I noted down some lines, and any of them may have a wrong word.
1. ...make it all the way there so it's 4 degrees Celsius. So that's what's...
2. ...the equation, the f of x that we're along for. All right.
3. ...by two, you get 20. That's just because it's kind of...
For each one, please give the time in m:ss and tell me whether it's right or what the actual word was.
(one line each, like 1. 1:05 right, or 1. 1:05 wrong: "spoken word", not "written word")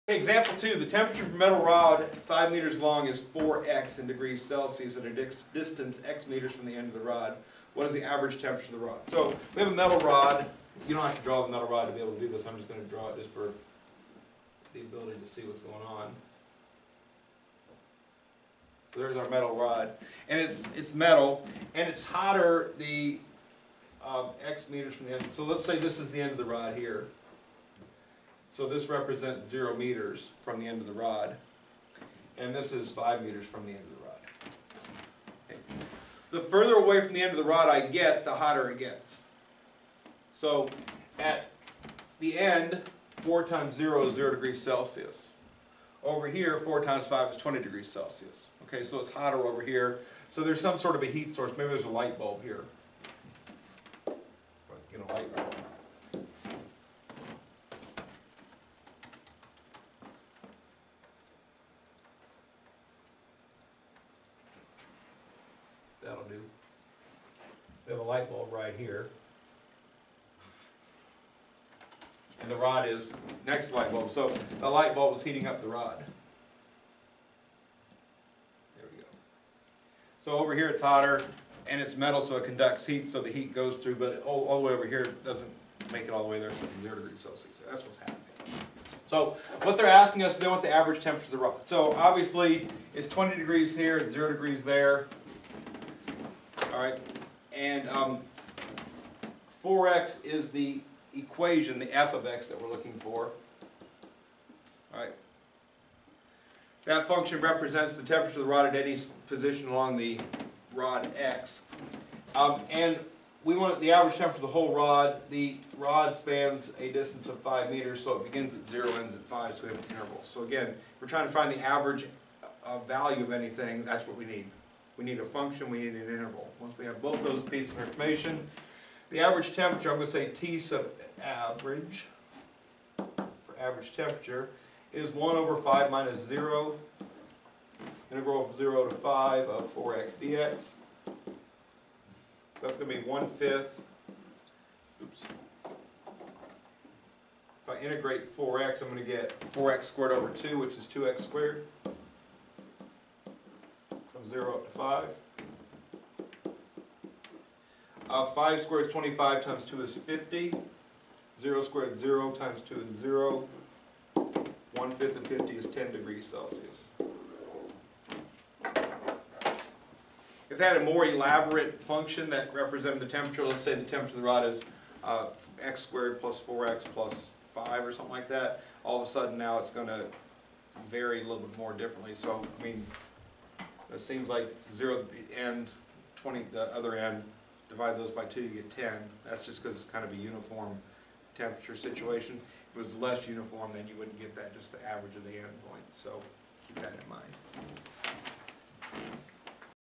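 1. 1:25 wrong: "0", not "4"
2. 1:40 wrong: "looking", not "along"
3. 3:08 wrong: "10", not "20".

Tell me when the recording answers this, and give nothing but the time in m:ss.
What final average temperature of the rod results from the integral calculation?
2:45.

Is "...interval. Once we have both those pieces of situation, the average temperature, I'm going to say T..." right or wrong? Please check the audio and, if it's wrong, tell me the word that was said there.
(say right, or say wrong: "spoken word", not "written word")
wrong: "information", not "situation".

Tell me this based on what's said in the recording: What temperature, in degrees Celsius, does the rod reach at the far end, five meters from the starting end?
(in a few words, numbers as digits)
20.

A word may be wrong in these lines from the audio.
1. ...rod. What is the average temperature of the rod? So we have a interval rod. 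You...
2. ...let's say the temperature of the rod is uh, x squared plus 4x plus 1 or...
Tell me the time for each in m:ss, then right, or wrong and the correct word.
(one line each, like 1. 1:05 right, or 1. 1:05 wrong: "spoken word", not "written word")
1. 0:06 wrong: "metal", not "interval"
2. 2:53 wrong: "5", not "1".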